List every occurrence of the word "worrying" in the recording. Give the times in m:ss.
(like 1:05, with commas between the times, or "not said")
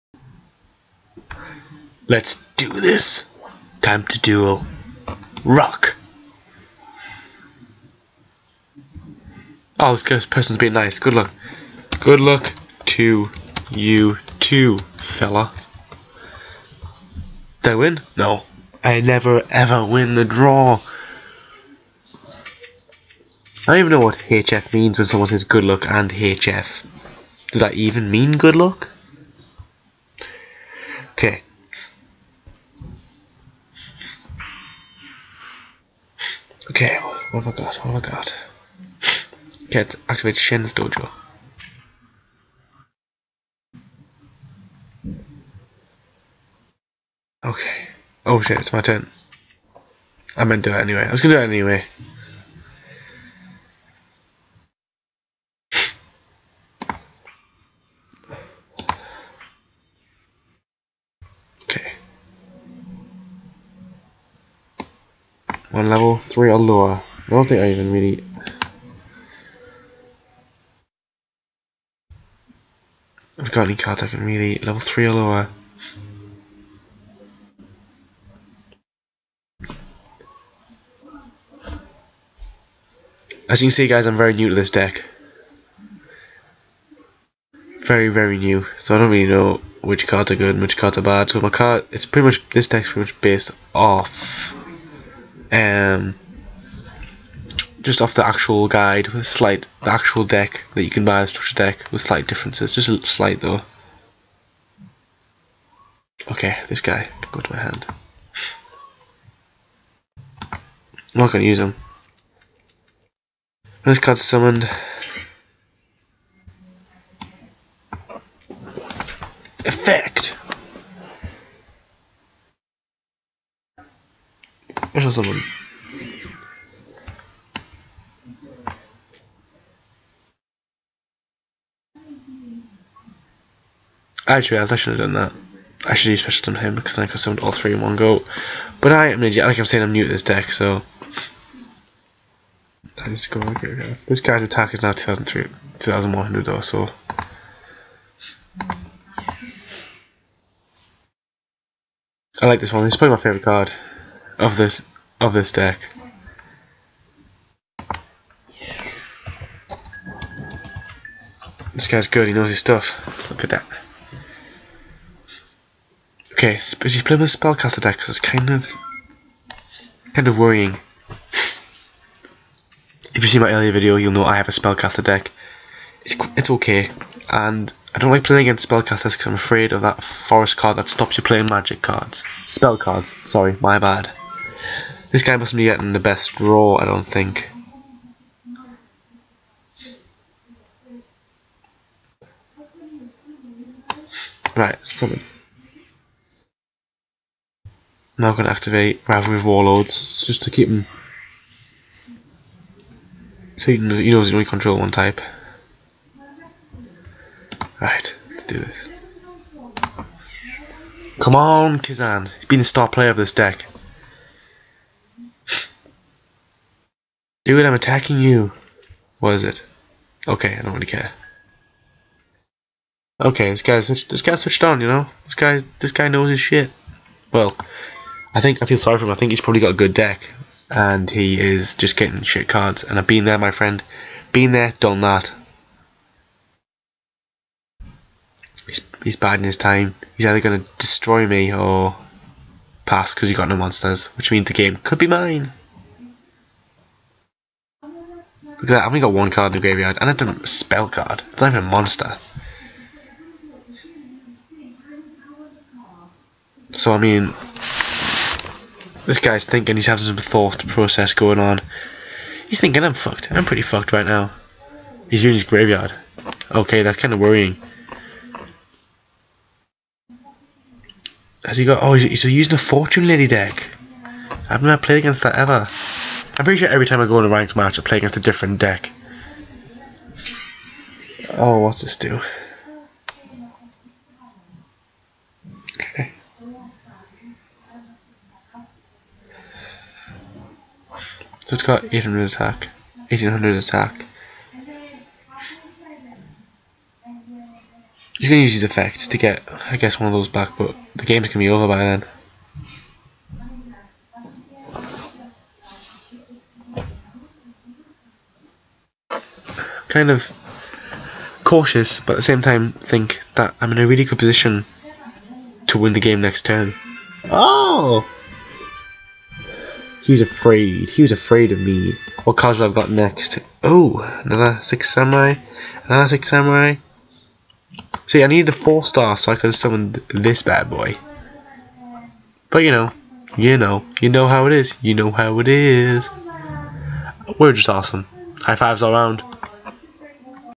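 2:50, 4:27.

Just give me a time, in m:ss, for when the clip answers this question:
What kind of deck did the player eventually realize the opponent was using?
4:32.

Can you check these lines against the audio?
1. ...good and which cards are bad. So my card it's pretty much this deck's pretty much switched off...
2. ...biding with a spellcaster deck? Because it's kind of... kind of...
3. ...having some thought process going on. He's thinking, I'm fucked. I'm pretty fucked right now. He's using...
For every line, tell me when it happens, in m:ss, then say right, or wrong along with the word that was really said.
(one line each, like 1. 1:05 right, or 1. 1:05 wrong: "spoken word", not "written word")
1. 1:30 wrong: "based", not "switched"
2. 2:47 wrong: "playing", not "biding"
3. 4:19 right.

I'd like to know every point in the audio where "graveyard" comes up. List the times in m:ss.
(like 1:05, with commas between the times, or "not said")
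4:09, 4:25.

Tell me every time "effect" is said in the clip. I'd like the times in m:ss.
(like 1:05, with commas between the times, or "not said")
1:59, 4:58.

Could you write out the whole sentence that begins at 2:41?
This guy's good, he knows his stuff.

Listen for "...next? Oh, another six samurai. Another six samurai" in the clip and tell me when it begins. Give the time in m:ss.
5:22.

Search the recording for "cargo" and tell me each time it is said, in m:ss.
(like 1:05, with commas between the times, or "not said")
not said.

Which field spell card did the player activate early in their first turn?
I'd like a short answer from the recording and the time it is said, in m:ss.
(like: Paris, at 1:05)
Shien's Dojo, at 0:40.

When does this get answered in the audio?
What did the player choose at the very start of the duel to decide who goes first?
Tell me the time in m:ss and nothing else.
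0:05.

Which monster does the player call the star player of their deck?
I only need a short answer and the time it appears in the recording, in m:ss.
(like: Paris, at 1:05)
Kizan, at 3:31.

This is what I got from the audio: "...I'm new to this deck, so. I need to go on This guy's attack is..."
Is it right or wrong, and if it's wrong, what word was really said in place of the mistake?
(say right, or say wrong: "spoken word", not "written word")
right.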